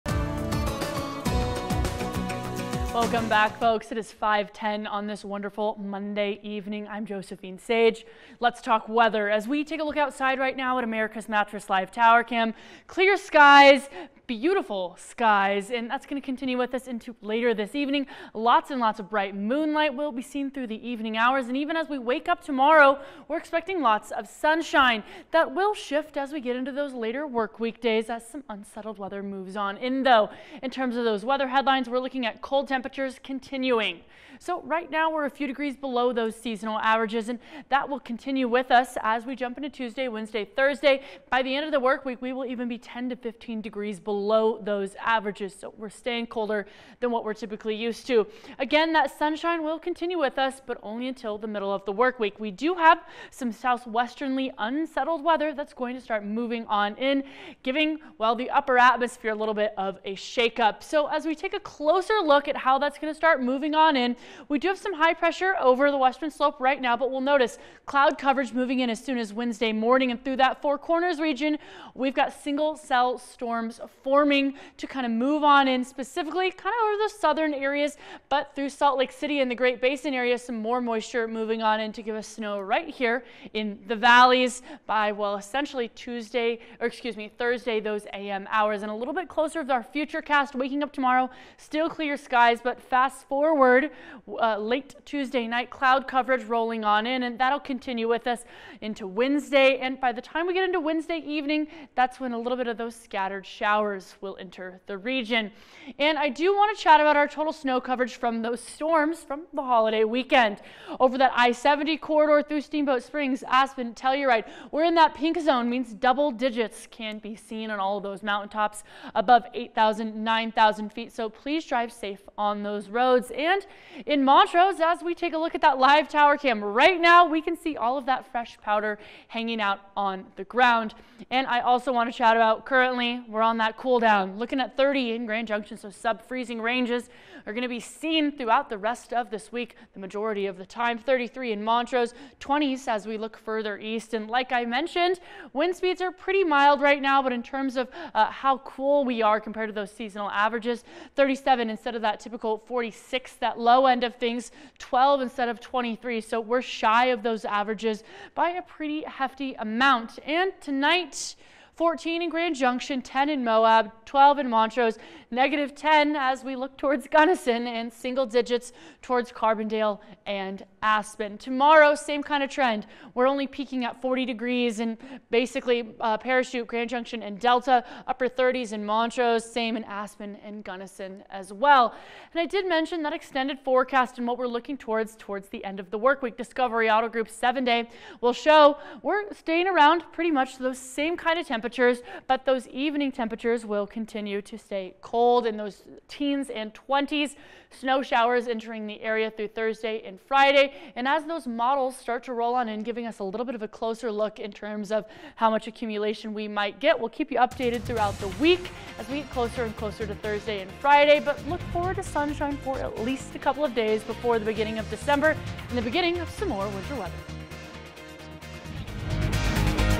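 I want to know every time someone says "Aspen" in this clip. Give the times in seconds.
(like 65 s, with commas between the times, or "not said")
113 s, 170 s, 179 s.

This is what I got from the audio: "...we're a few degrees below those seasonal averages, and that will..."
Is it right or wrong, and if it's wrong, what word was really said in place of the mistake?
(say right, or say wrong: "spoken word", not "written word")
right.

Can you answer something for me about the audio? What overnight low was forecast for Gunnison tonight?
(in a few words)
-10.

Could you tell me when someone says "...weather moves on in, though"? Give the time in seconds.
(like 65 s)
28 s.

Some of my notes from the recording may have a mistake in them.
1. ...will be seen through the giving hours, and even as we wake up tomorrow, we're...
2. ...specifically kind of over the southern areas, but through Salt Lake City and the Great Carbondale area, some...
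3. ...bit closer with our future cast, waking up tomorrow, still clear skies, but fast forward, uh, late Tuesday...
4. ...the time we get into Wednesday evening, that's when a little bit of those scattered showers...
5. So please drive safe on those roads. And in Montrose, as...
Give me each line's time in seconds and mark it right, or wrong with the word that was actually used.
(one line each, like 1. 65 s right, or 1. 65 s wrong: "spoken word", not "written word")
1. 19 s wrong: "evening", not "giving"
2. 75 s wrong: "Basin", not "Carbondale"
3. 89 s right
4. 100 s right
5. 121 s right.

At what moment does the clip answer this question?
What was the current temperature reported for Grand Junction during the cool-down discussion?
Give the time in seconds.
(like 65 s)
134 s.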